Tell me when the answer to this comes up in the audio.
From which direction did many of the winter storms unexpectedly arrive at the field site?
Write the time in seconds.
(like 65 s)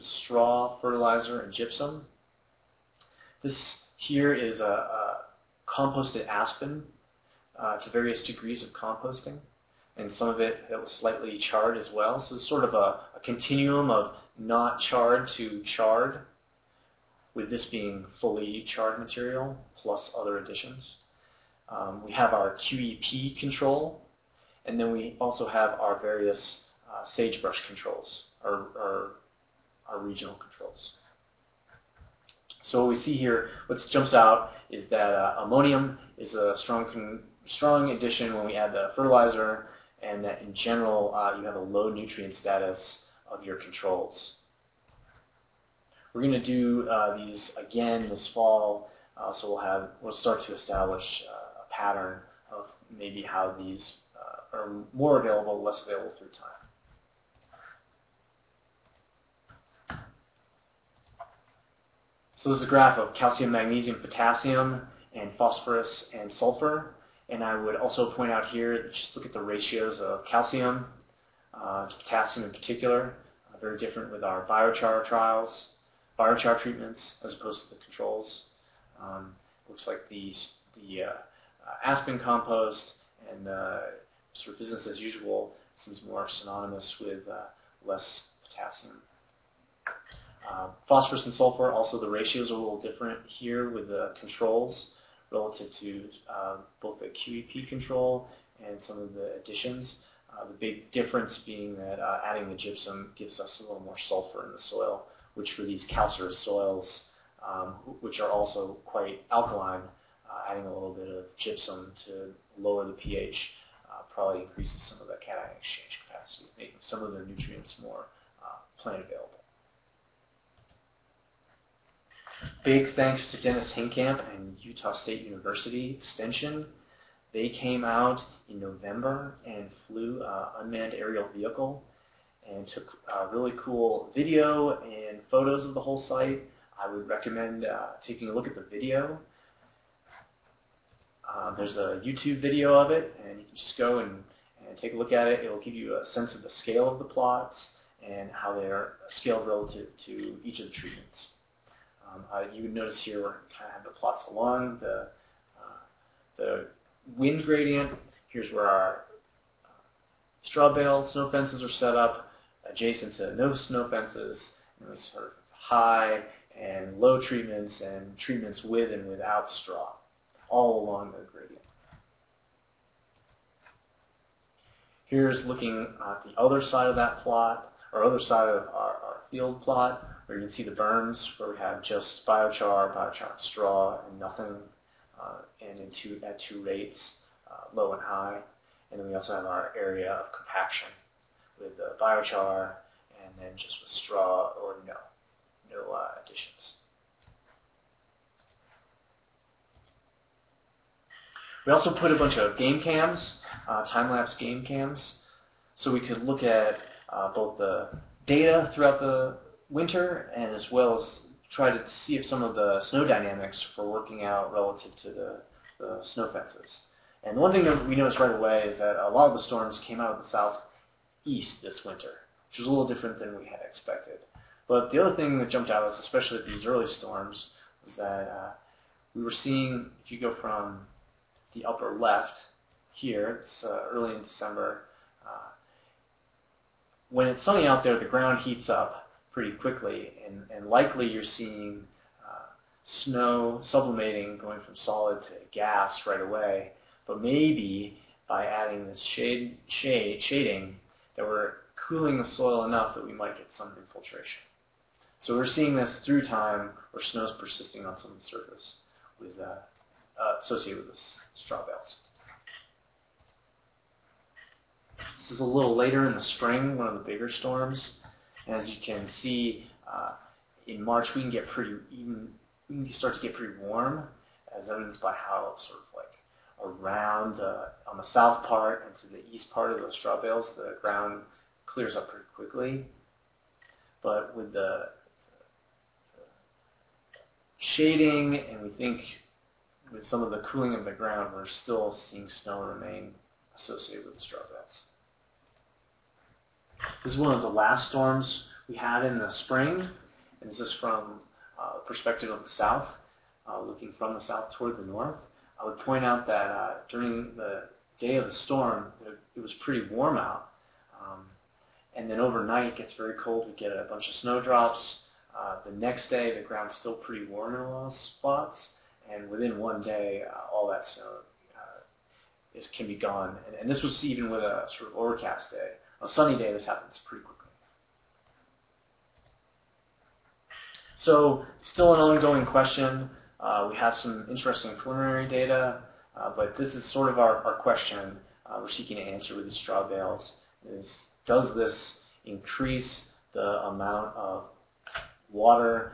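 220 s.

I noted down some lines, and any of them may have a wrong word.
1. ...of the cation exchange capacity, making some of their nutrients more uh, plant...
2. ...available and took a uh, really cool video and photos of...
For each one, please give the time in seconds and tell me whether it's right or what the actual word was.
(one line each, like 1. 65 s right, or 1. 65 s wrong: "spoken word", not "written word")
1. 114 s right
2. 131 s wrong: "vehicle", not "available".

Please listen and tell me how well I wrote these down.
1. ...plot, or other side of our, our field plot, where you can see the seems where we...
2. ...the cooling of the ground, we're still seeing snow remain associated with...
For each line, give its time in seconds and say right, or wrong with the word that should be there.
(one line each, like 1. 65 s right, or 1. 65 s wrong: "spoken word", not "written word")
1. 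177 s wrong: "berms", not "seems"
2. 290 s right.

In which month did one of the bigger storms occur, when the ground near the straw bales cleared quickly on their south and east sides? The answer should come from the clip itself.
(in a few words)
March.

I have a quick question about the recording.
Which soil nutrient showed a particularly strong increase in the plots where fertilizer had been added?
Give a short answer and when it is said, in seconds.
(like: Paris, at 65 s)
Ammonium, at 35 s.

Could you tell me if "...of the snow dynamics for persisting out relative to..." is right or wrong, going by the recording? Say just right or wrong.
wrong.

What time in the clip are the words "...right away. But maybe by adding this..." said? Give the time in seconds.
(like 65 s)
246 s.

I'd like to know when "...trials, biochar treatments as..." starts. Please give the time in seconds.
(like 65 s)
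75 s.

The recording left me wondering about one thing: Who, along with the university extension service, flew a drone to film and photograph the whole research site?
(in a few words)
Dennis Hinkamp.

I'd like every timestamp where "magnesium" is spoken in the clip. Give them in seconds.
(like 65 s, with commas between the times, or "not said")
63 s.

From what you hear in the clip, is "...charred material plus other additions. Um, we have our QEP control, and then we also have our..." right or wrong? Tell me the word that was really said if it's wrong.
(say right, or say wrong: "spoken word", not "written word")
right.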